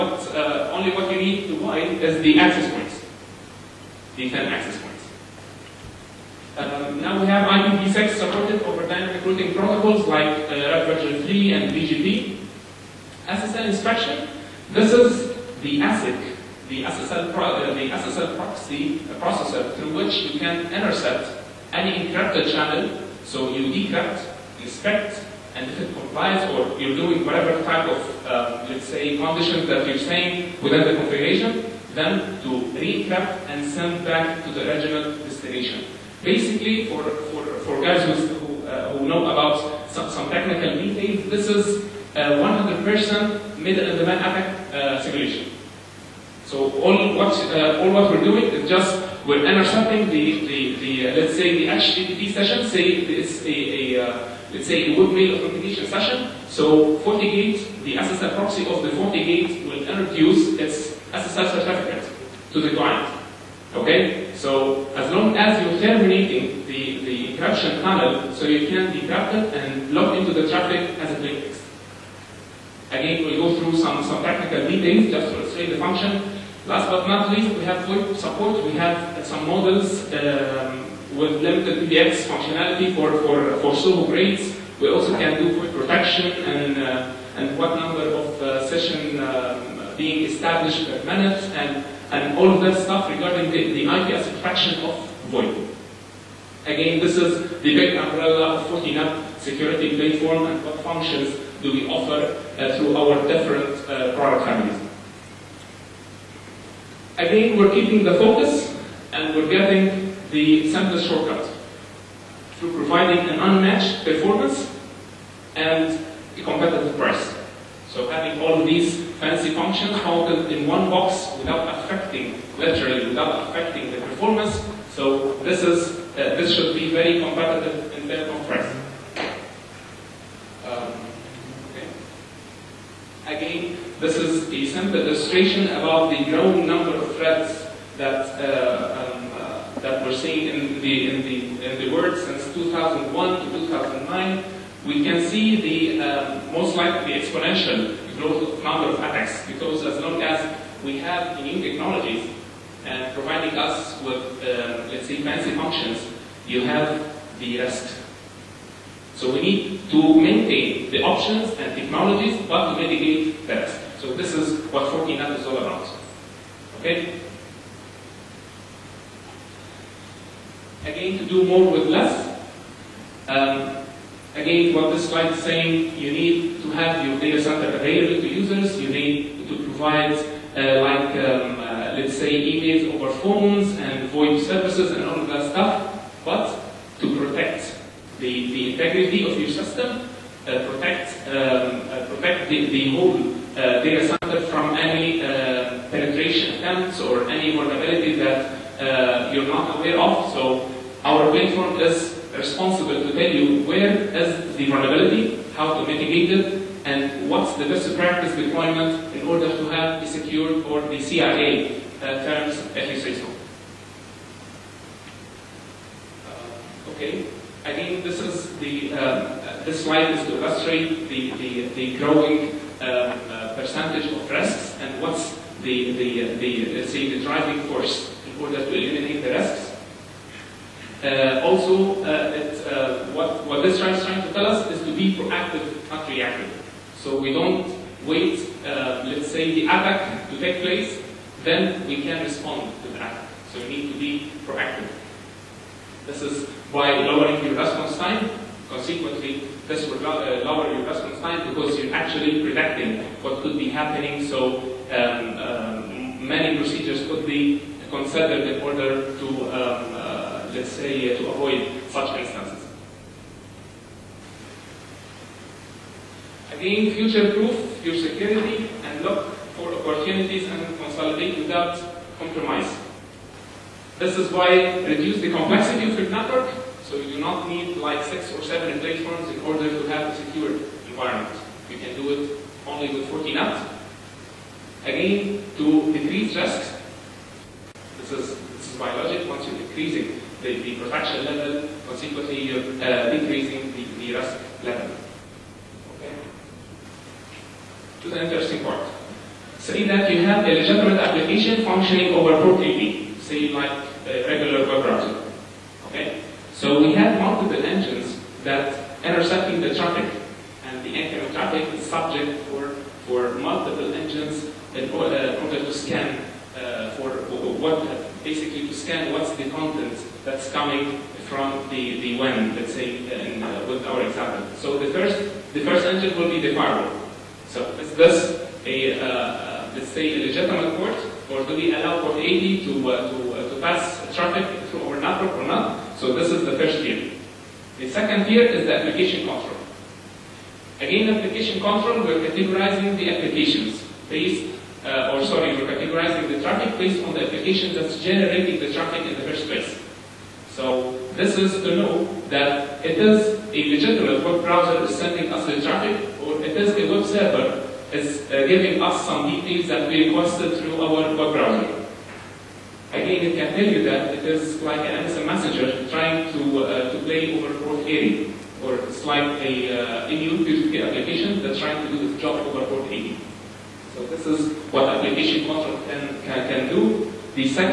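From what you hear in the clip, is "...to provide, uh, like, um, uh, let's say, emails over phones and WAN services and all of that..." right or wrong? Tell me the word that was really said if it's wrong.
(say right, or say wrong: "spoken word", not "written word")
wrong: "VoIP", not "WAN".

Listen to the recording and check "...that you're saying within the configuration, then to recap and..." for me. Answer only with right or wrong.
right.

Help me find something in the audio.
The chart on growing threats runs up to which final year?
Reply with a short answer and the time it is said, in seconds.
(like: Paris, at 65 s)
2009, at 143 s.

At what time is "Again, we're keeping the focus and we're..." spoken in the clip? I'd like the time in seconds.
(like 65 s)
107 s.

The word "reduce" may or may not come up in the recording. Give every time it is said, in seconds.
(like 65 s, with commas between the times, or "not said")
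274 s.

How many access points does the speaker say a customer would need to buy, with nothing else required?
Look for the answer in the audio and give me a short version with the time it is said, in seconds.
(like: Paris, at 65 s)
10, at 4 s.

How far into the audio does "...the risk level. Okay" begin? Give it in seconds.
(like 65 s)
293 s.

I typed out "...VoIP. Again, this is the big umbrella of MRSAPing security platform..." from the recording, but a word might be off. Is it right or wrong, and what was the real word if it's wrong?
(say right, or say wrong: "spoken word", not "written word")
wrong: "Fortinet", not "MRSAPing".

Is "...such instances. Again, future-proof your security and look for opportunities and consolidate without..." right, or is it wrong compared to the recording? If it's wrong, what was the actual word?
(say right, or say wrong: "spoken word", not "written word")
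right.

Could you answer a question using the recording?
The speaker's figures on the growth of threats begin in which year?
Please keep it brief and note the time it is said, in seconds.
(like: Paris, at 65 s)
2001, at 142 s.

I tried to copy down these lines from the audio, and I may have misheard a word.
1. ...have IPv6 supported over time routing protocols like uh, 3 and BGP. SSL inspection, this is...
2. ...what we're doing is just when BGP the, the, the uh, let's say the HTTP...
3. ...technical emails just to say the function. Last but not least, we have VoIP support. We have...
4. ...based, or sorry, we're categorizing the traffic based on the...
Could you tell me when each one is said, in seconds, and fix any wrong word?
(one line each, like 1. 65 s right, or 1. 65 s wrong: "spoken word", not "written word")
1. 7 s right
2. 47 s wrong: "MRSAPing", not "BGP"
3. 74 s wrong: "details", not "emails"
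4. 344 s right.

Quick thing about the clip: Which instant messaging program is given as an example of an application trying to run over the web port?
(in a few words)
MSN Messenger.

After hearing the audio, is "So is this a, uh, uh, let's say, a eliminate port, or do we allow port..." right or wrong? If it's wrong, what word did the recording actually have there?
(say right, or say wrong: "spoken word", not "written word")
wrong: "legitimate", not "eliminate".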